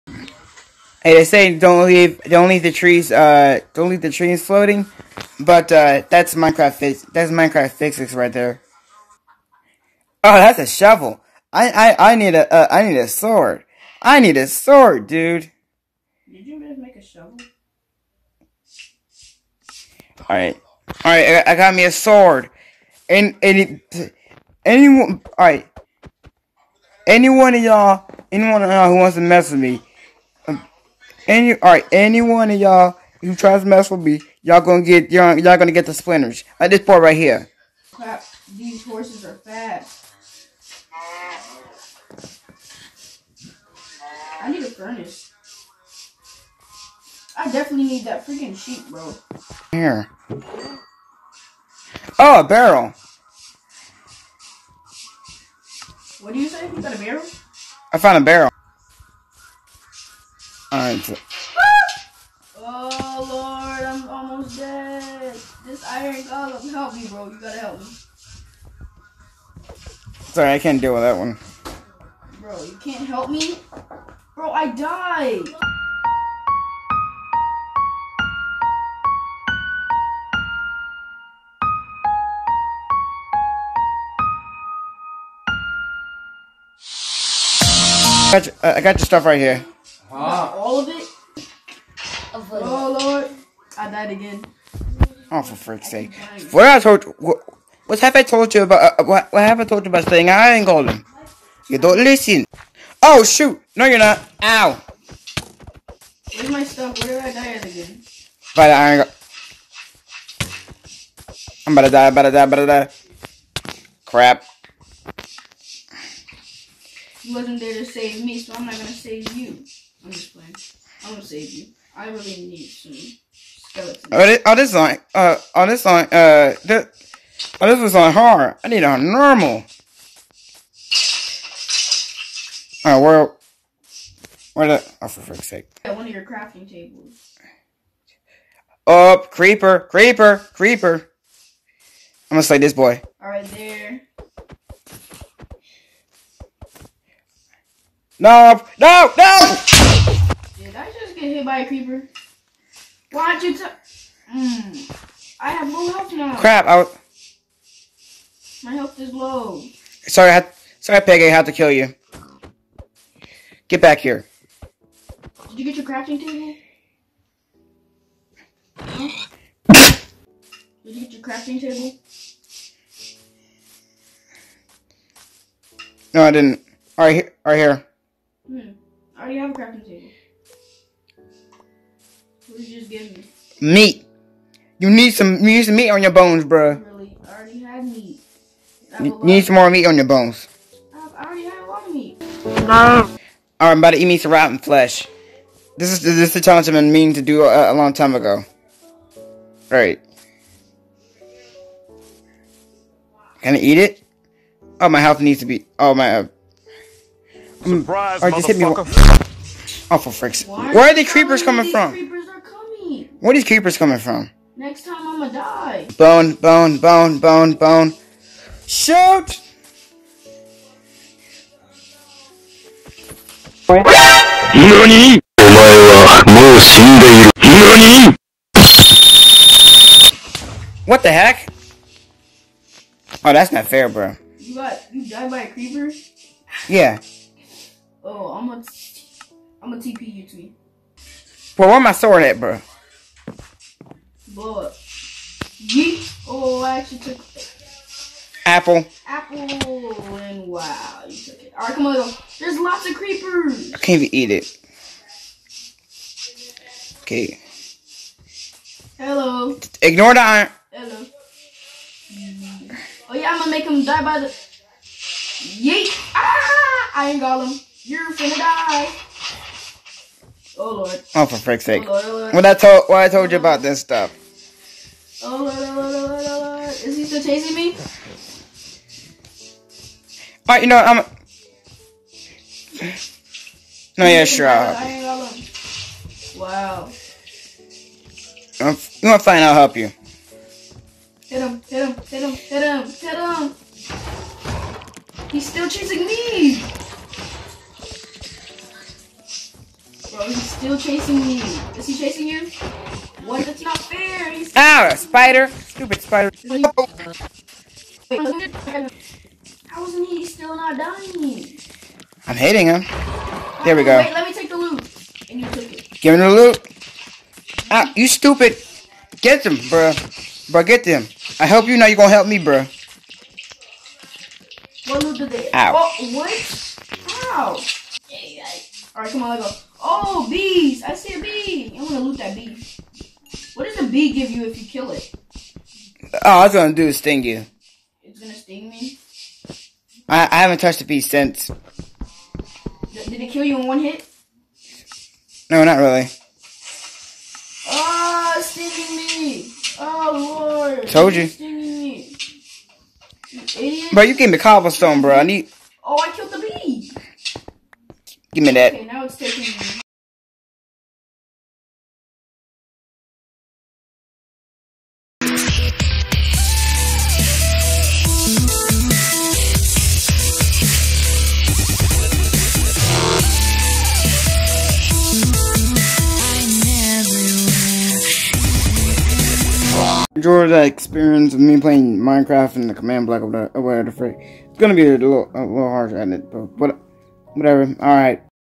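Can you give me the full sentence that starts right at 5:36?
All it's gonna do is sting you.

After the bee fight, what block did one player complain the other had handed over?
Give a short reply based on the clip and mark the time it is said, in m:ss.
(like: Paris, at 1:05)
Cobblestone, at 5:54.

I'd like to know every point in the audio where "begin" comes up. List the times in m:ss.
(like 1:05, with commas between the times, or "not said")
not said.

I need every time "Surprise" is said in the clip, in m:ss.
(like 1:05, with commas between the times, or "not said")
3:27.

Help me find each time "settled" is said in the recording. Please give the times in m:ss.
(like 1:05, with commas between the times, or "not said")
not said.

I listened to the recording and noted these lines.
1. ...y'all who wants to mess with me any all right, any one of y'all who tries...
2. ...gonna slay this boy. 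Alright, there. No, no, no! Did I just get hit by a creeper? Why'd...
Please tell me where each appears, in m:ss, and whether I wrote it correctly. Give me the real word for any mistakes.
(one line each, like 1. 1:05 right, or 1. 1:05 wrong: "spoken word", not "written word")
1. 0:28 right
2. 2:22 right.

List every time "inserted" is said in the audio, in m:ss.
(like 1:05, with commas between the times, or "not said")
not said.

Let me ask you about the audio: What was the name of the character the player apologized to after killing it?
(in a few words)
Peggy.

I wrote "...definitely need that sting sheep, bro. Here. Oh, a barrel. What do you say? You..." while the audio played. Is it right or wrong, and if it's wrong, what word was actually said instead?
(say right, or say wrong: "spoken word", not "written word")
wrong: "freaking", not "sting".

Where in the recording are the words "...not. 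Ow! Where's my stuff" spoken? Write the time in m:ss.
1:43.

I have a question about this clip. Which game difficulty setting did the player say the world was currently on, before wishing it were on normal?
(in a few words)
Hard.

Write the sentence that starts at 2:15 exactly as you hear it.
At one of your crafting tables.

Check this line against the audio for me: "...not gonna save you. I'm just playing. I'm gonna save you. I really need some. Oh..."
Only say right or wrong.
right.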